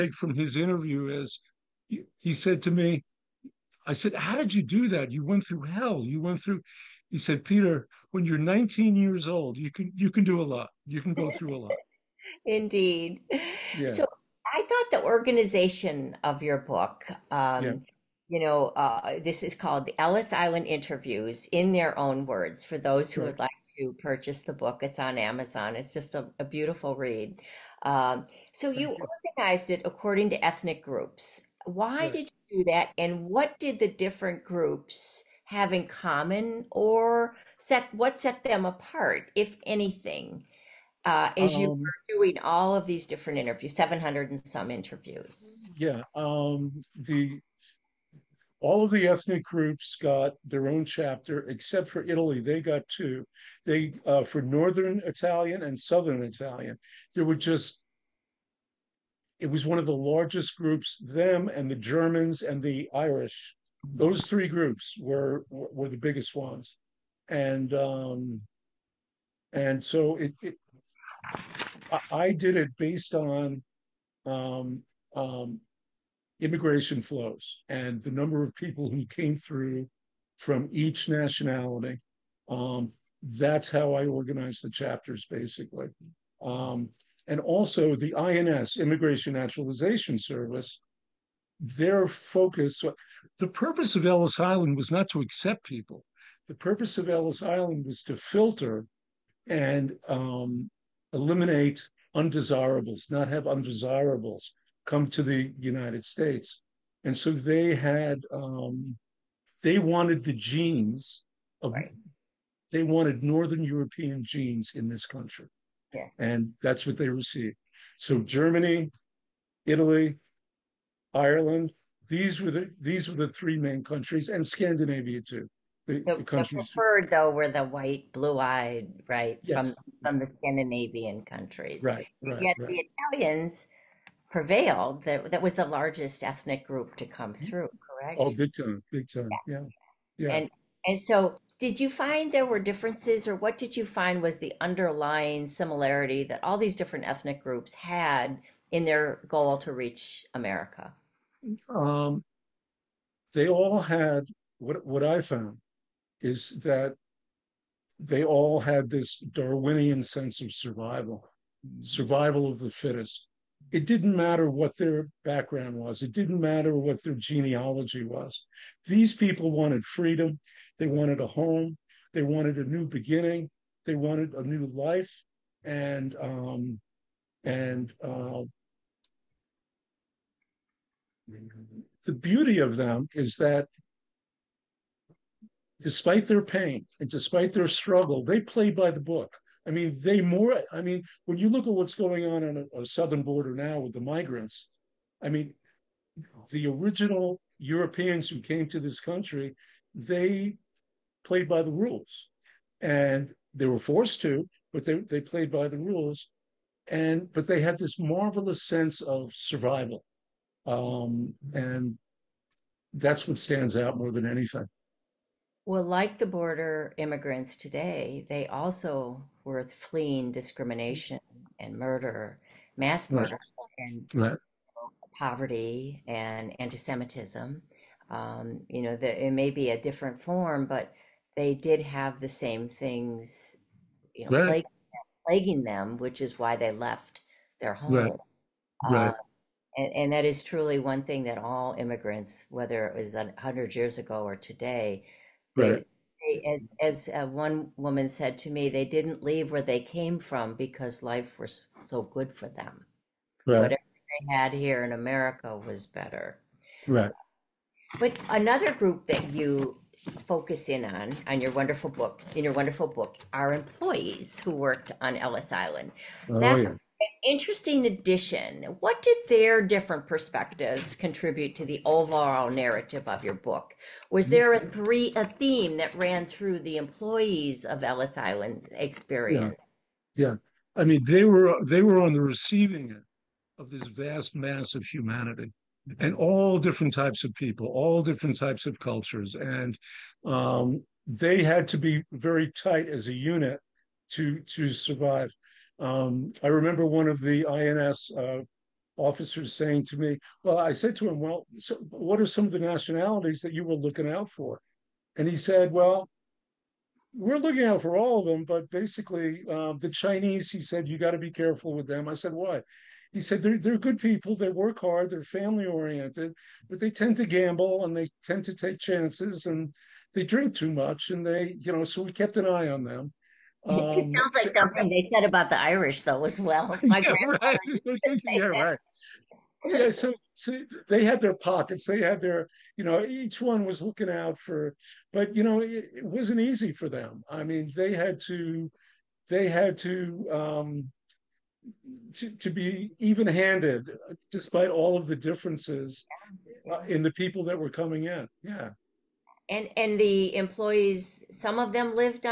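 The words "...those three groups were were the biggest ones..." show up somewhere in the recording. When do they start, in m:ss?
1:03.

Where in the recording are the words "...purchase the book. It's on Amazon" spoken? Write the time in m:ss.
0:24.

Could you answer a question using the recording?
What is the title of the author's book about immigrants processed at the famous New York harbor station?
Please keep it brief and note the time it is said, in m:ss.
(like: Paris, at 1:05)
The Ellis Island Interviews, at 0:19.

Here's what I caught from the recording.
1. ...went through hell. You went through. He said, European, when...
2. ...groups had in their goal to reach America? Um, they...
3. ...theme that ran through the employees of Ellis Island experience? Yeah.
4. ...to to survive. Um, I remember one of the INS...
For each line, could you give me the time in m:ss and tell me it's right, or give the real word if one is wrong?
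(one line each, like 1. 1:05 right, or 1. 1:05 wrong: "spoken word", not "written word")
1. 0:05 wrong: "Peter", not "European"
2. 2:27 right
3. 4:35 right
4. 4:54 right.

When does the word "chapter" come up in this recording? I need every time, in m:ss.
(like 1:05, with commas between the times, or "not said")
0:50, 1:24.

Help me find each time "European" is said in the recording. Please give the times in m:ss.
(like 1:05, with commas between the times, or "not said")
1:53, 3:17.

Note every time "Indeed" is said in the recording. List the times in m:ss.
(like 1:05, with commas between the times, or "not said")
0:12.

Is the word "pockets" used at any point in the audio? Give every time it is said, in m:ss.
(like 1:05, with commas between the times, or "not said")
5:31.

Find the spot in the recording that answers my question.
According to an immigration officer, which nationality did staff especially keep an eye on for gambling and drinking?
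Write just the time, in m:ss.
5:09.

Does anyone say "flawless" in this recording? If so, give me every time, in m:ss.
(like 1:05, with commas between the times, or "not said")
not said.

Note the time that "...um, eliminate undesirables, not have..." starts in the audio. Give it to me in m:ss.
1:40.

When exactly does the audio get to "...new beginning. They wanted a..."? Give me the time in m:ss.
2:52.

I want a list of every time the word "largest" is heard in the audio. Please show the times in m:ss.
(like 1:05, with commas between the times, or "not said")
0:59, 2:15.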